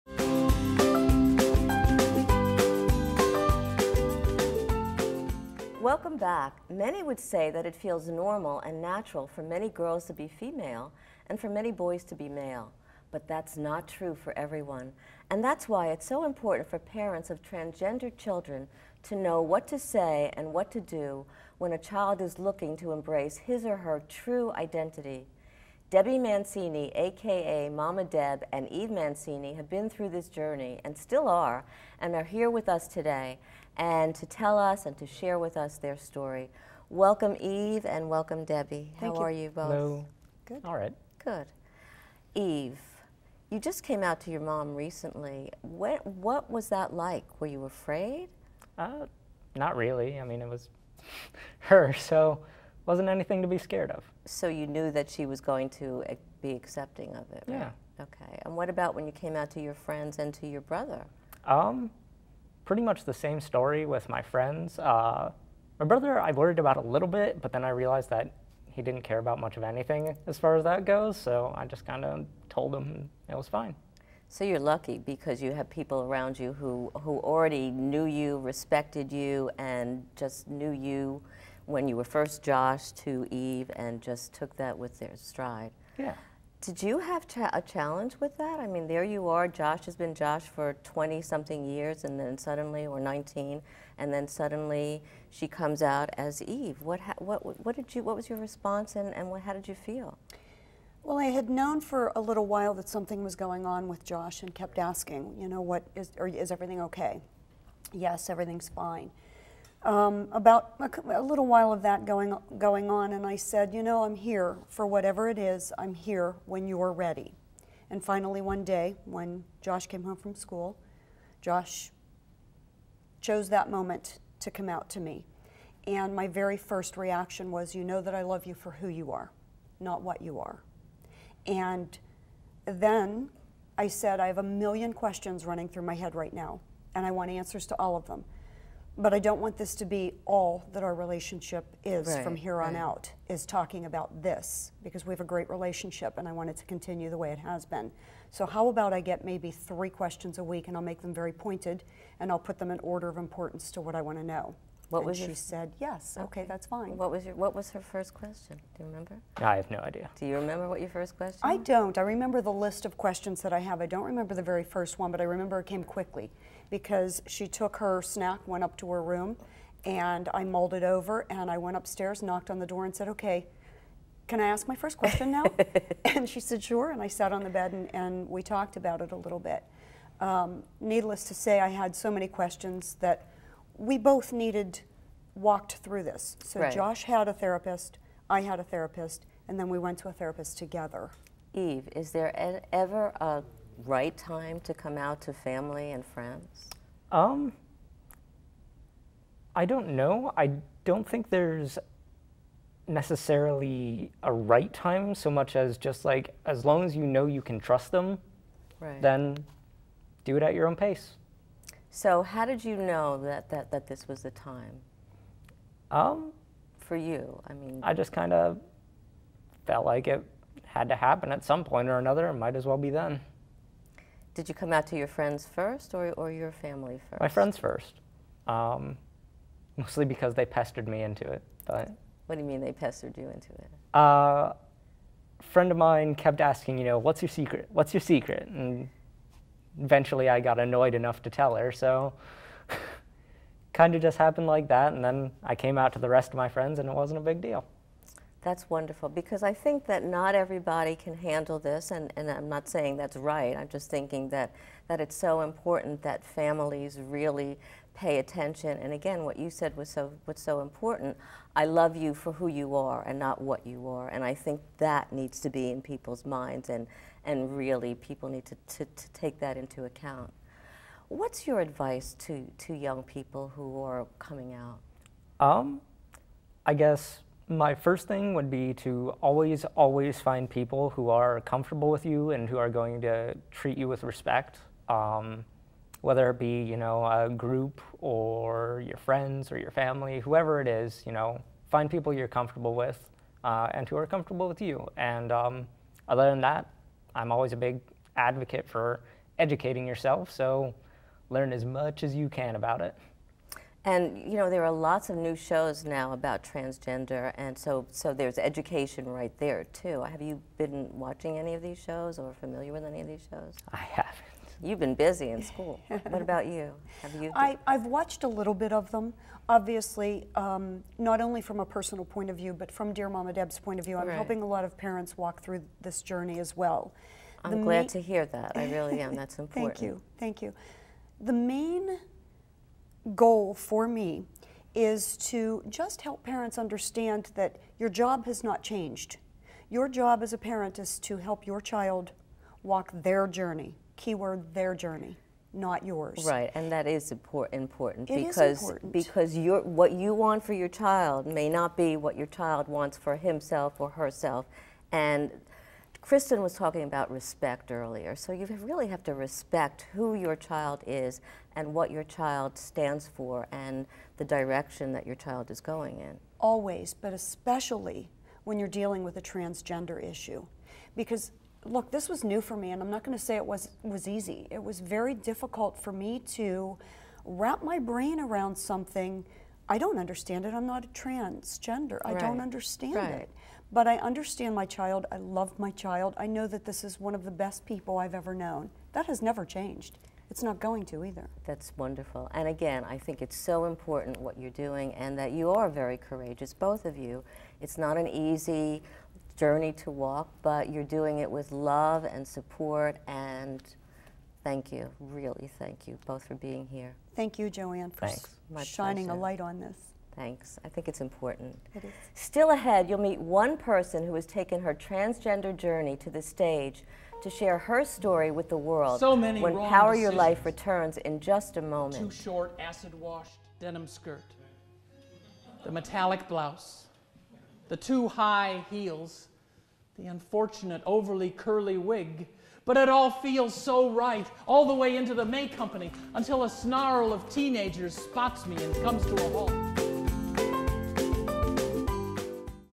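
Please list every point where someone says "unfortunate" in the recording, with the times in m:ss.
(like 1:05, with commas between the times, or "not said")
7:10.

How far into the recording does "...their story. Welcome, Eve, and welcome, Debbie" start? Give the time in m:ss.
0:35.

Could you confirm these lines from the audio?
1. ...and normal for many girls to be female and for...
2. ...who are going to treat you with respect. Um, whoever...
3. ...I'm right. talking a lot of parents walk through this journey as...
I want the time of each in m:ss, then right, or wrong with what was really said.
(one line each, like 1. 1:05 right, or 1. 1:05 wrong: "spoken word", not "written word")
1. 0:08 wrong: "natural", not "normal"
2. 4:42 wrong: "whether", not "whoever"
3. 5:23 wrong: "helping", not "talking".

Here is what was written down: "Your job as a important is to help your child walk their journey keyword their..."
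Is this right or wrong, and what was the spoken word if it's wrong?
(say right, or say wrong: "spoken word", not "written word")
wrong: "parent", not "important".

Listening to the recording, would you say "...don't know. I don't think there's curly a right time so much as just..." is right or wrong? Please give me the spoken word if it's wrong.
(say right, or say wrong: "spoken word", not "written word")
wrong: "necessarily", not "curly".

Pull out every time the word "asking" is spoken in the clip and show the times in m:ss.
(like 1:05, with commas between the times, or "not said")
1:44, 3:56.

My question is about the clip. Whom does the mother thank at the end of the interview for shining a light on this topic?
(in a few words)
Jo Anne.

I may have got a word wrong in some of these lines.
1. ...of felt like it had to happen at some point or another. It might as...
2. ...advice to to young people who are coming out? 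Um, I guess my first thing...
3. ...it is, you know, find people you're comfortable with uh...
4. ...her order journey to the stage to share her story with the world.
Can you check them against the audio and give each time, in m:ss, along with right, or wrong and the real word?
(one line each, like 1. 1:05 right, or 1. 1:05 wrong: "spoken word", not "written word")
1. 3:38 right
2. 4:31 right
3. 4:50 right
4. 6:54 wrong: "transgender", not "order".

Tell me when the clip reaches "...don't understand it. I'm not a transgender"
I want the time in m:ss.
6:19.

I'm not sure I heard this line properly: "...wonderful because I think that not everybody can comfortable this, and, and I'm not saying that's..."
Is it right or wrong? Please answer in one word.
wrong.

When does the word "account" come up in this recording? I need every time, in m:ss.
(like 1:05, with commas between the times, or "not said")
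4:29.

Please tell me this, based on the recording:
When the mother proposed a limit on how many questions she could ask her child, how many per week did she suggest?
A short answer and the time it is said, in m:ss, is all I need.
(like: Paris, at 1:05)
3, at 2:29.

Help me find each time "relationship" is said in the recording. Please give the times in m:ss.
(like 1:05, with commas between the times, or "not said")
2:20, 2:25.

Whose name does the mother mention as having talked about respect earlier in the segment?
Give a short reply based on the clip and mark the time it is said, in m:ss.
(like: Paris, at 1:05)
Kristen, at 5:55.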